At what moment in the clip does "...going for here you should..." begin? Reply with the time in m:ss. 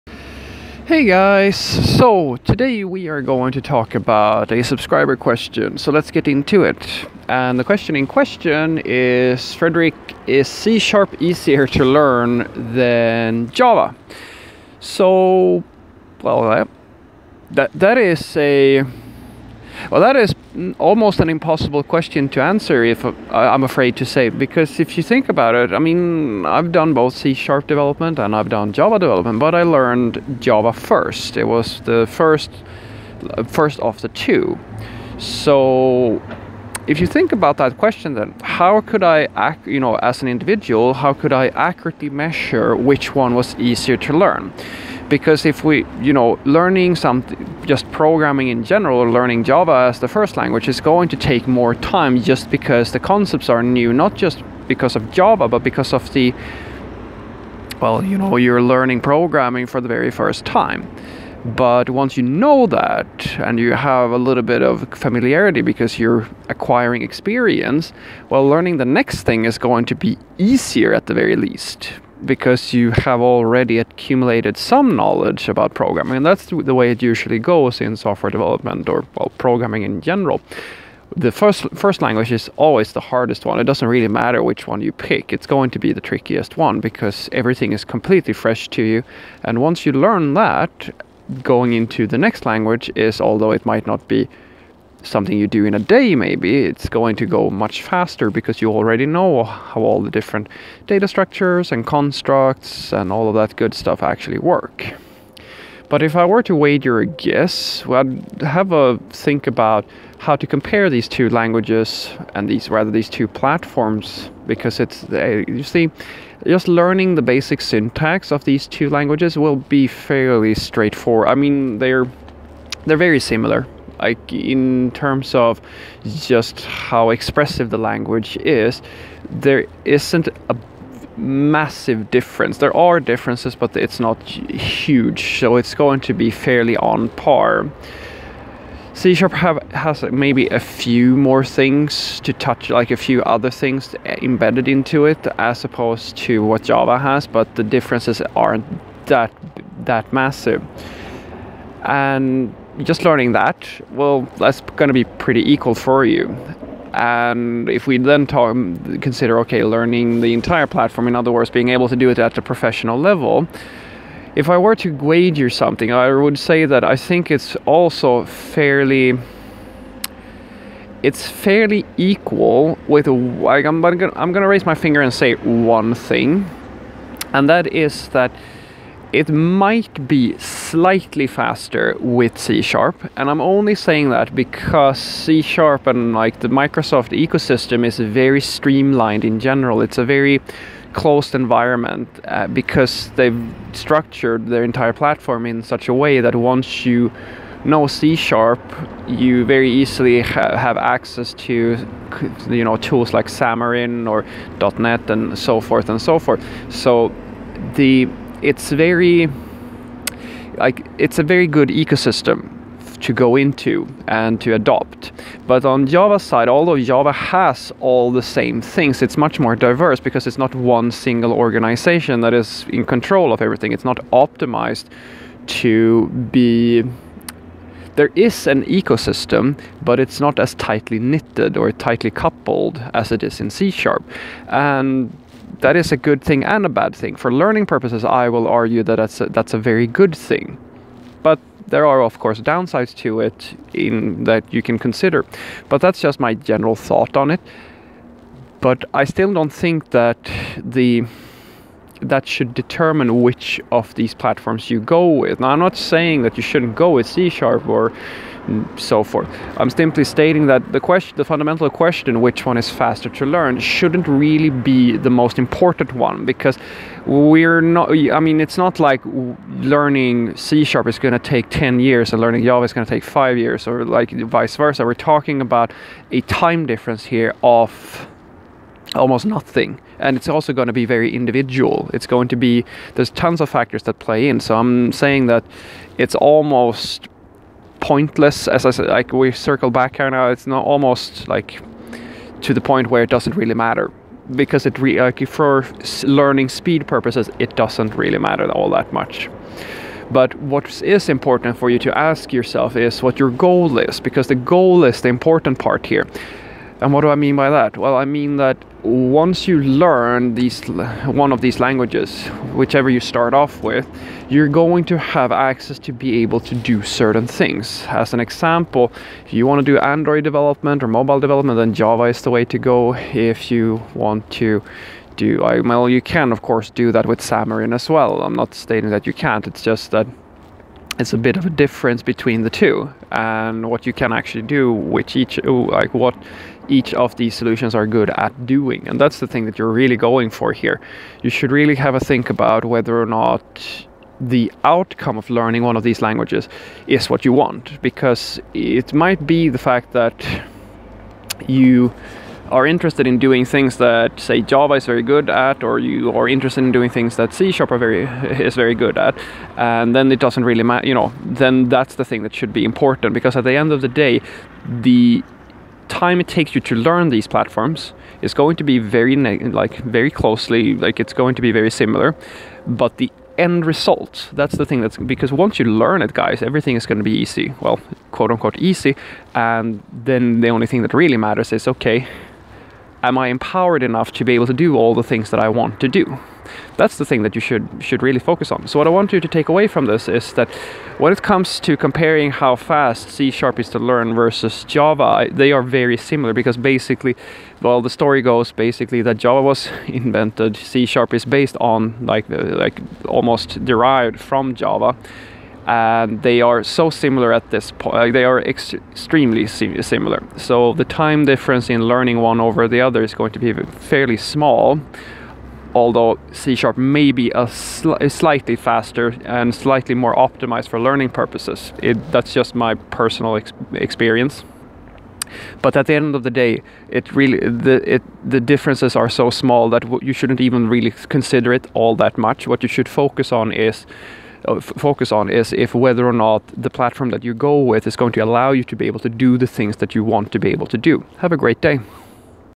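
5:39.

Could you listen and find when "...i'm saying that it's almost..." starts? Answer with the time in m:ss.
4:44.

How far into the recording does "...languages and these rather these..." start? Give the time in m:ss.
1:51.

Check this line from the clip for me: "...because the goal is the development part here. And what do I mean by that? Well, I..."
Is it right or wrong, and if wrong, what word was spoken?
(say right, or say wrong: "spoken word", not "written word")
wrong: "important", not "development".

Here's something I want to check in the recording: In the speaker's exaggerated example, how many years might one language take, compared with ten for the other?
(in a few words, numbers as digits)
5.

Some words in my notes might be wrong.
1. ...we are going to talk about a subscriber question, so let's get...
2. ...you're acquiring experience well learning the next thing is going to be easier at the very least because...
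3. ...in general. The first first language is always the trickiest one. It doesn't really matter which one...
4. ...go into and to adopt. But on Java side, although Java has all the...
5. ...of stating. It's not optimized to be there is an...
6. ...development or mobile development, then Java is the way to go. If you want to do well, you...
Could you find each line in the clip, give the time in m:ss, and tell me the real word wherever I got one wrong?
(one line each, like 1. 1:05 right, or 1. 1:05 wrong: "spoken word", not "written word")
1. 0:02 right
2. 1:05 right
3. 1:19 wrong: "hardest", not "trickiest"
4. 3:33 right
5. 3:43 wrong: "everything", not "stating"
6. 5:20 right.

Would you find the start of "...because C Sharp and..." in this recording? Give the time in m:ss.
3:04.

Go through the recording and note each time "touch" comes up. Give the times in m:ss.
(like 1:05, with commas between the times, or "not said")
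2:22.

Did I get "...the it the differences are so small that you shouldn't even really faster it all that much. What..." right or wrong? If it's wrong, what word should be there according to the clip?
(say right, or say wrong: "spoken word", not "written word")
wrong: "consider", not "faster".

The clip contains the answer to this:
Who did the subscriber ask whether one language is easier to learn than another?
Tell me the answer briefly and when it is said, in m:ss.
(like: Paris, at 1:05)
Fredrik, at 0:09.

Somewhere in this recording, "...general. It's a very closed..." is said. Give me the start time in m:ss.
3:09.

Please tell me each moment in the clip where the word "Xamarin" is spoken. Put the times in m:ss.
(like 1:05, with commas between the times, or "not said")
3:23, 5:27.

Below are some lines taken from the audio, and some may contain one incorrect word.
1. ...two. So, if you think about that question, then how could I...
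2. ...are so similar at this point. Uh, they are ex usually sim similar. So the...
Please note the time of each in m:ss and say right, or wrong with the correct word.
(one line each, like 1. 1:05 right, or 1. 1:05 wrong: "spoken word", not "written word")
1. 0:34 right
2. 6:46 wrong: "extremely", not "usually".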